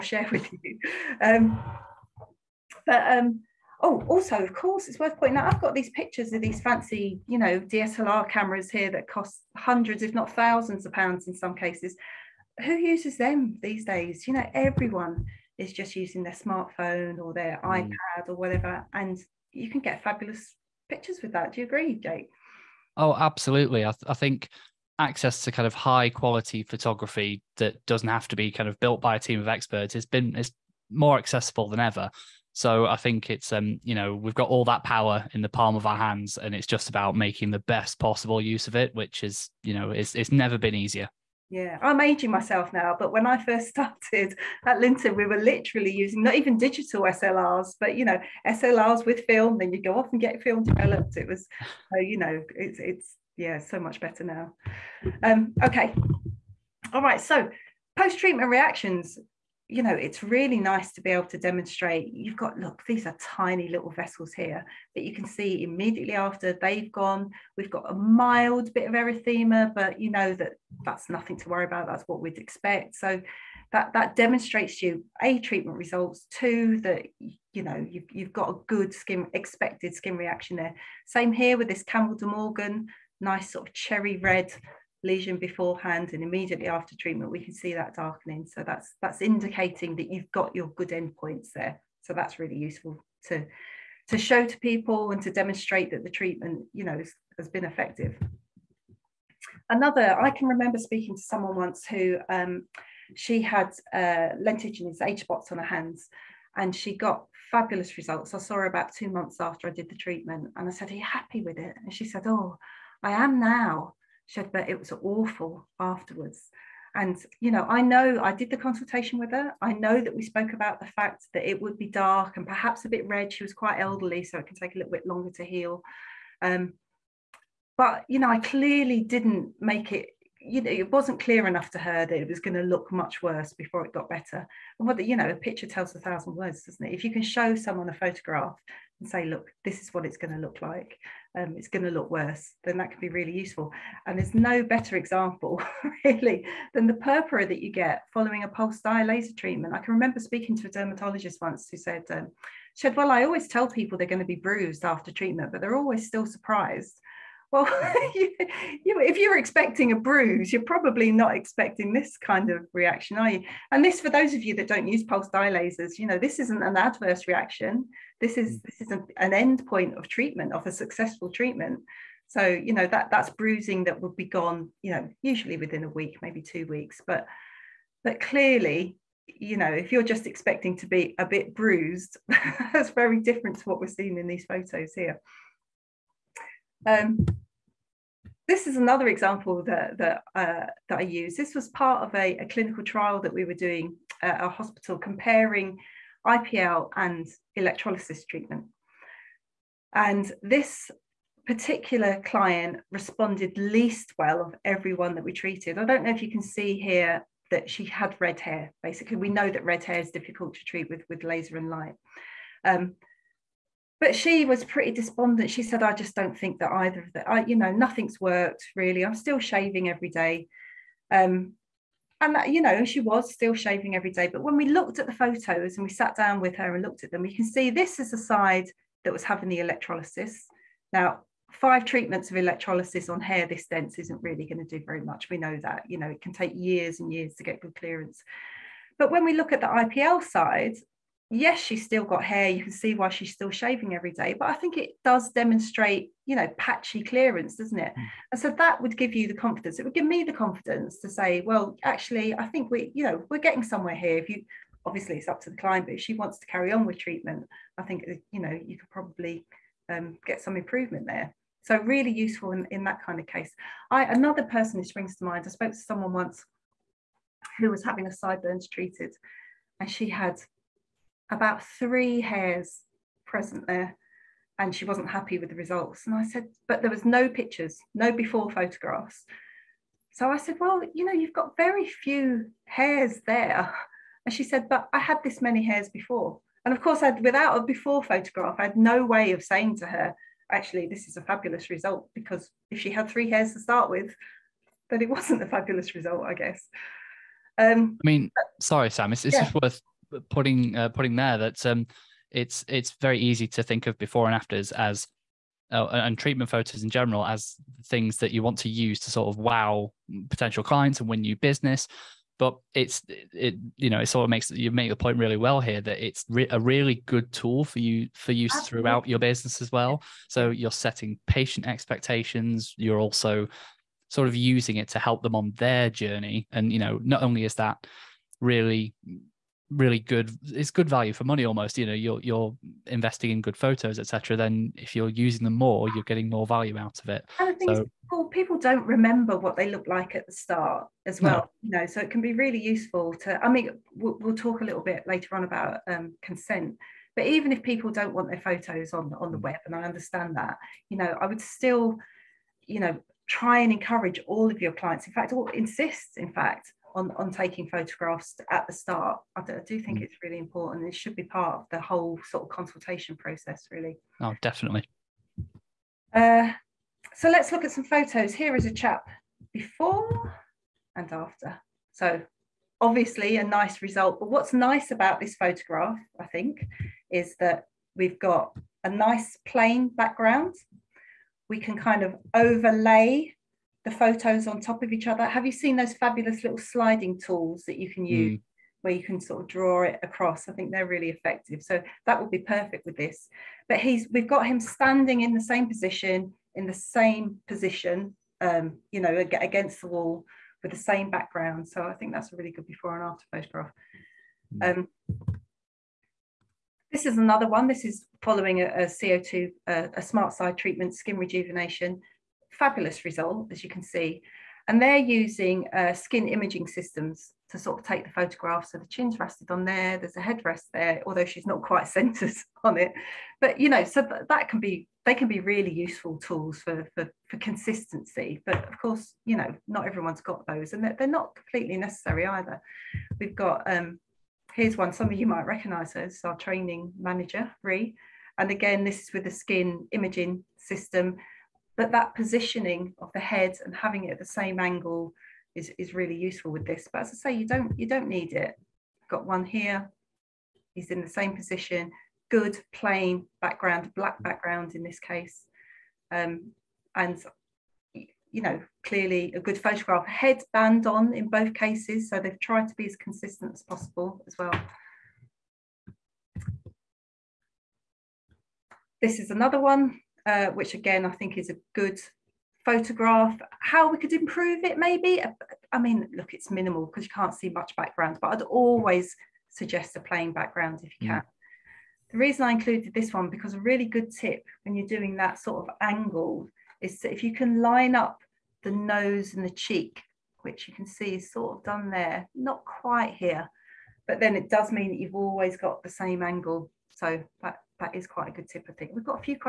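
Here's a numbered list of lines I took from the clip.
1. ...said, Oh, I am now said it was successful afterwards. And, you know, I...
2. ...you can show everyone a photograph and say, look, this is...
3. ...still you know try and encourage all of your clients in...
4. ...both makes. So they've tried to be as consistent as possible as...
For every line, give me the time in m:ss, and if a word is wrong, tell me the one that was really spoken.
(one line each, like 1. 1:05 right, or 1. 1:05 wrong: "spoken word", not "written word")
1. 1:52 wrong: "awful", not "successful"
2. 2:17 wrong: "someone", not "everyone"
3. 5:51 right
4. 7:41 wrong: "cases", not "makes".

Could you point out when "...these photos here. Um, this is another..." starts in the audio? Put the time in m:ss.
3:04.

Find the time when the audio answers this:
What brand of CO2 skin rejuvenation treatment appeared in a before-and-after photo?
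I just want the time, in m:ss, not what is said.
6:50.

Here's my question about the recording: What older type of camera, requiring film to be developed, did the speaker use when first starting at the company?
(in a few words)
SLRs with film.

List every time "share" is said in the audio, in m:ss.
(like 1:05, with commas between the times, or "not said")
0:00.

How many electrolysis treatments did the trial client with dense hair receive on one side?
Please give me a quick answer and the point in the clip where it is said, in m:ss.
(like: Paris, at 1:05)
5, at 3:51.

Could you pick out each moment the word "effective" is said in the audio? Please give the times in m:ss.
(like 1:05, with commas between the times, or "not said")
1:37, 6:31.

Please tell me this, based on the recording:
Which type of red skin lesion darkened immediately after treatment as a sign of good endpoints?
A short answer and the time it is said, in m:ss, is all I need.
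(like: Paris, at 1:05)
Campbell de Morgan, at 1:21.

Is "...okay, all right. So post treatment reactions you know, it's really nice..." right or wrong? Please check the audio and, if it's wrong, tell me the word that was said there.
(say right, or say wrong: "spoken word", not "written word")
right.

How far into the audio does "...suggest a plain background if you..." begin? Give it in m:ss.
7:59.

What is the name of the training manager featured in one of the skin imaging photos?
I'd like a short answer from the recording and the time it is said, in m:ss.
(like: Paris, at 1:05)
Ree, at 7:17.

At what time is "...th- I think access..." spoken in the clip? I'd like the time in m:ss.
0:23.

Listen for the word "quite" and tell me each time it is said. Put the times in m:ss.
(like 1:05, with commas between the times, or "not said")
2:03, 7:01, 8:12, 8:18.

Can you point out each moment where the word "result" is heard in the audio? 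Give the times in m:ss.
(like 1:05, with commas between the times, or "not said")
1:15, 1:47, 4:35, 4:51, 4:55, 6:13, 6:53.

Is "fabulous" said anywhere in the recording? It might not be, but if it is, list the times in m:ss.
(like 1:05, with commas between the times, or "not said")
0:20, 1:47, 4:51, 4:55, 6:25, 6:52.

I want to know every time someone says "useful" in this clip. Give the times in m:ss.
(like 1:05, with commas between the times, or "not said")
1:32, 2:23, 4:22, 5:42, 7:05, 7:26.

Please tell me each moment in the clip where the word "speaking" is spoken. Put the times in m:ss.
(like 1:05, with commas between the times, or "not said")
1:40, 2:30.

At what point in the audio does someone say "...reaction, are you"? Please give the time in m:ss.
2:42.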